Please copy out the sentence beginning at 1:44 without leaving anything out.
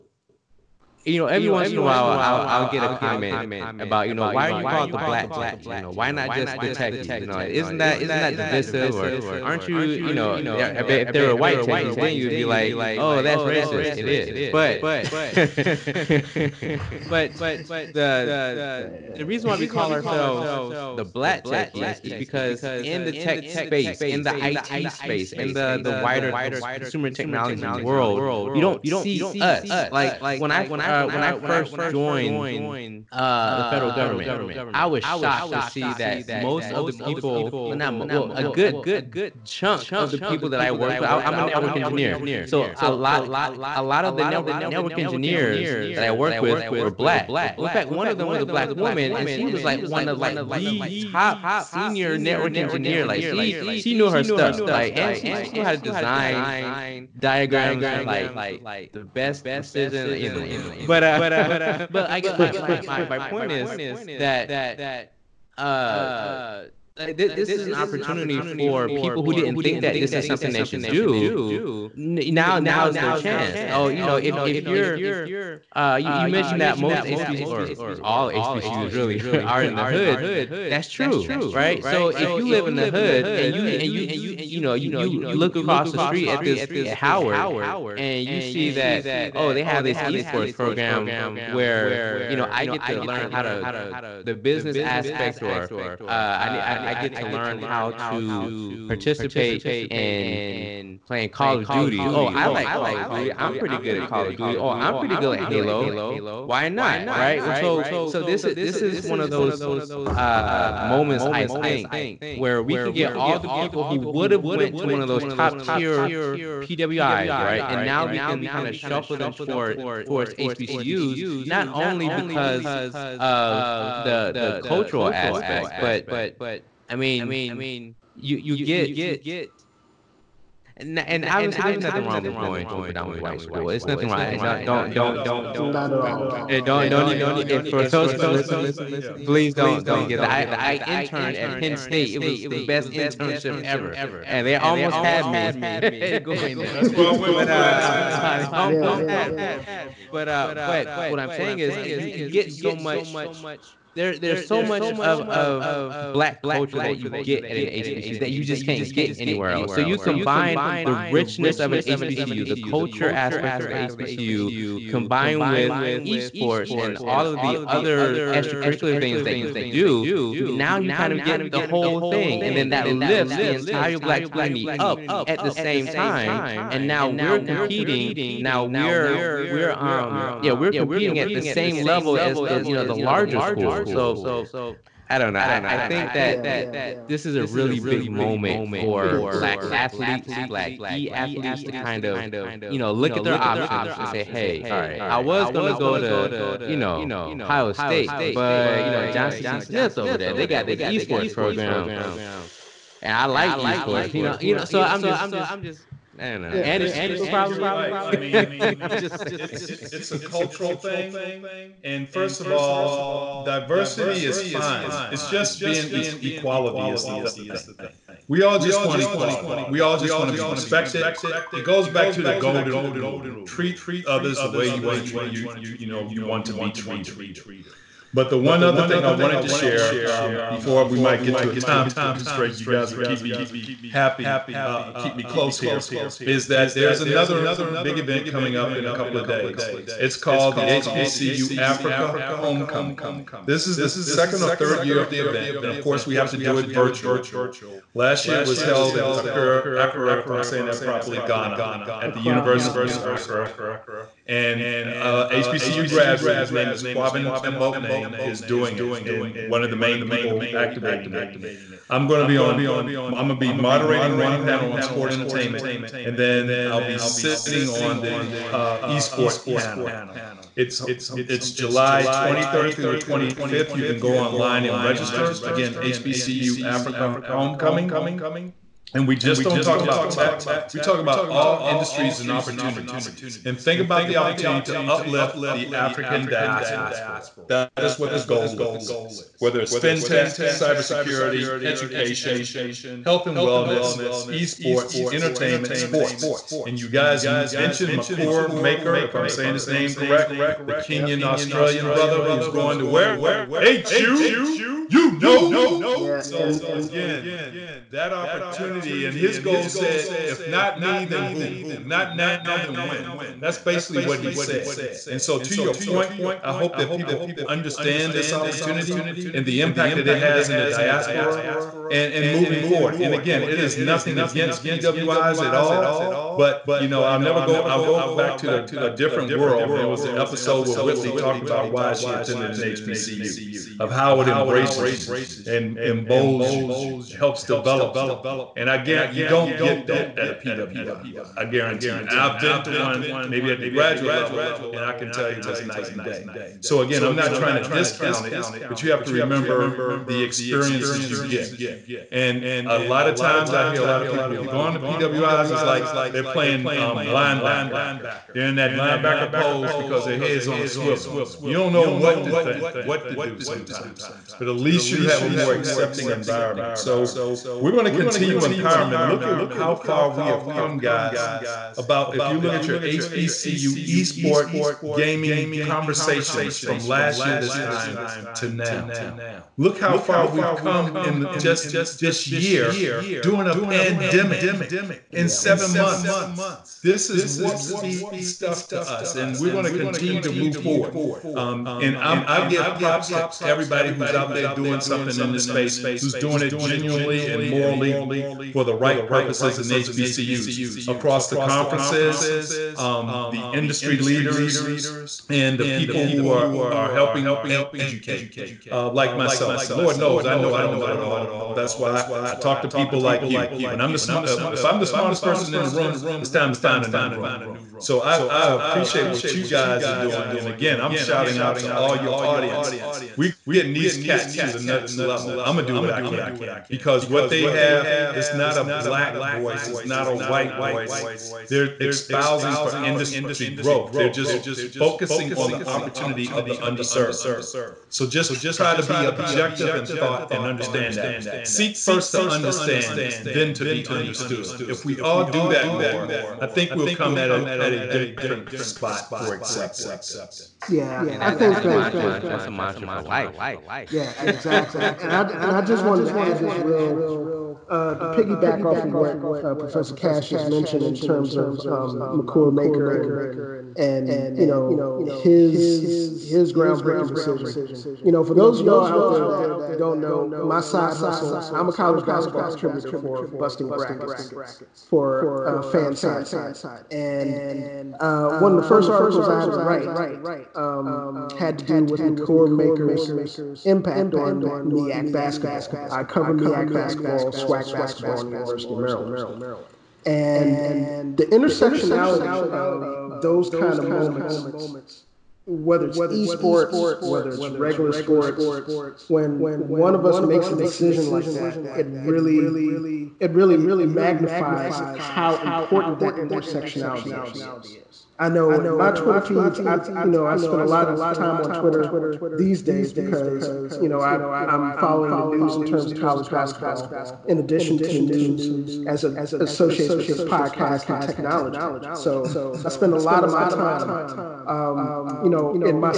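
Oh, I'm pretty good at Halo.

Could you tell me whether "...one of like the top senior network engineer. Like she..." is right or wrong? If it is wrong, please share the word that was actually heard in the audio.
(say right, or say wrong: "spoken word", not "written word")
right.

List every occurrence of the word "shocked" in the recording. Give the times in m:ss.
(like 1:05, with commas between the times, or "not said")
0:35.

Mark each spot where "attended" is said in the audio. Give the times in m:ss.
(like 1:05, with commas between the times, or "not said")
5:32.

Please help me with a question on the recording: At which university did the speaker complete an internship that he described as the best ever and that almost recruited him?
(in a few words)
Penn State.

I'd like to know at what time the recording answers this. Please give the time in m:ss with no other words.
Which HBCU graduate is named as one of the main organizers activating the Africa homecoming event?
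4:16.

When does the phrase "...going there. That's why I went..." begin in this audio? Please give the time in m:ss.
2:26.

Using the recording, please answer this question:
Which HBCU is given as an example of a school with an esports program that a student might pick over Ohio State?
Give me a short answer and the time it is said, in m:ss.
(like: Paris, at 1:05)
Johnson C. Smith, at 3:19.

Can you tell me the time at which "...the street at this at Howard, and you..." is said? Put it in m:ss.
1:25.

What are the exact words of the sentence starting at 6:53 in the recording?
When I'm the smart, uh, if I'm the smartest person in the room, it's time to find a new room.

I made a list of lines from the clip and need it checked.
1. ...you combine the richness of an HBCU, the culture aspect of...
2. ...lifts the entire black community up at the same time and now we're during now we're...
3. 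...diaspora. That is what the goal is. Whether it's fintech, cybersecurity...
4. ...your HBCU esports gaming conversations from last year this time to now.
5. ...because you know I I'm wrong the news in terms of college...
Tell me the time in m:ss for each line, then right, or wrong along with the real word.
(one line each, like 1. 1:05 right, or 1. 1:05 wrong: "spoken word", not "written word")
1. 2:39 right
2. 2:52 wrong: "competing", not "during"
3. 4:46 right
4. 6:12 right
5. 8:32 wrong: "following", not "wrong".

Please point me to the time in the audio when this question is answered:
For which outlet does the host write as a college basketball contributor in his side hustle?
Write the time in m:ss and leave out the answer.
7:53.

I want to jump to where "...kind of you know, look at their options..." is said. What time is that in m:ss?
3:11.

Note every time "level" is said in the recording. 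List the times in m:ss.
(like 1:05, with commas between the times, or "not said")
3:01, 5:44, 7:04.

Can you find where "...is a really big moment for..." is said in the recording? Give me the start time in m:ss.
3:07.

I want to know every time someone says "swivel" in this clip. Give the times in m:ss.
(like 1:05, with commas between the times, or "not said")
6:00.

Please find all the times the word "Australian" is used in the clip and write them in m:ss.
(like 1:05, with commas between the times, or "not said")
5:01.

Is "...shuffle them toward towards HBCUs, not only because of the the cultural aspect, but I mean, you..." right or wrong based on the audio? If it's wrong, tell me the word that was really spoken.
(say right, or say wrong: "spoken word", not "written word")
right.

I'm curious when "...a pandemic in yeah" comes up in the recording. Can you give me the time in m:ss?
6:23.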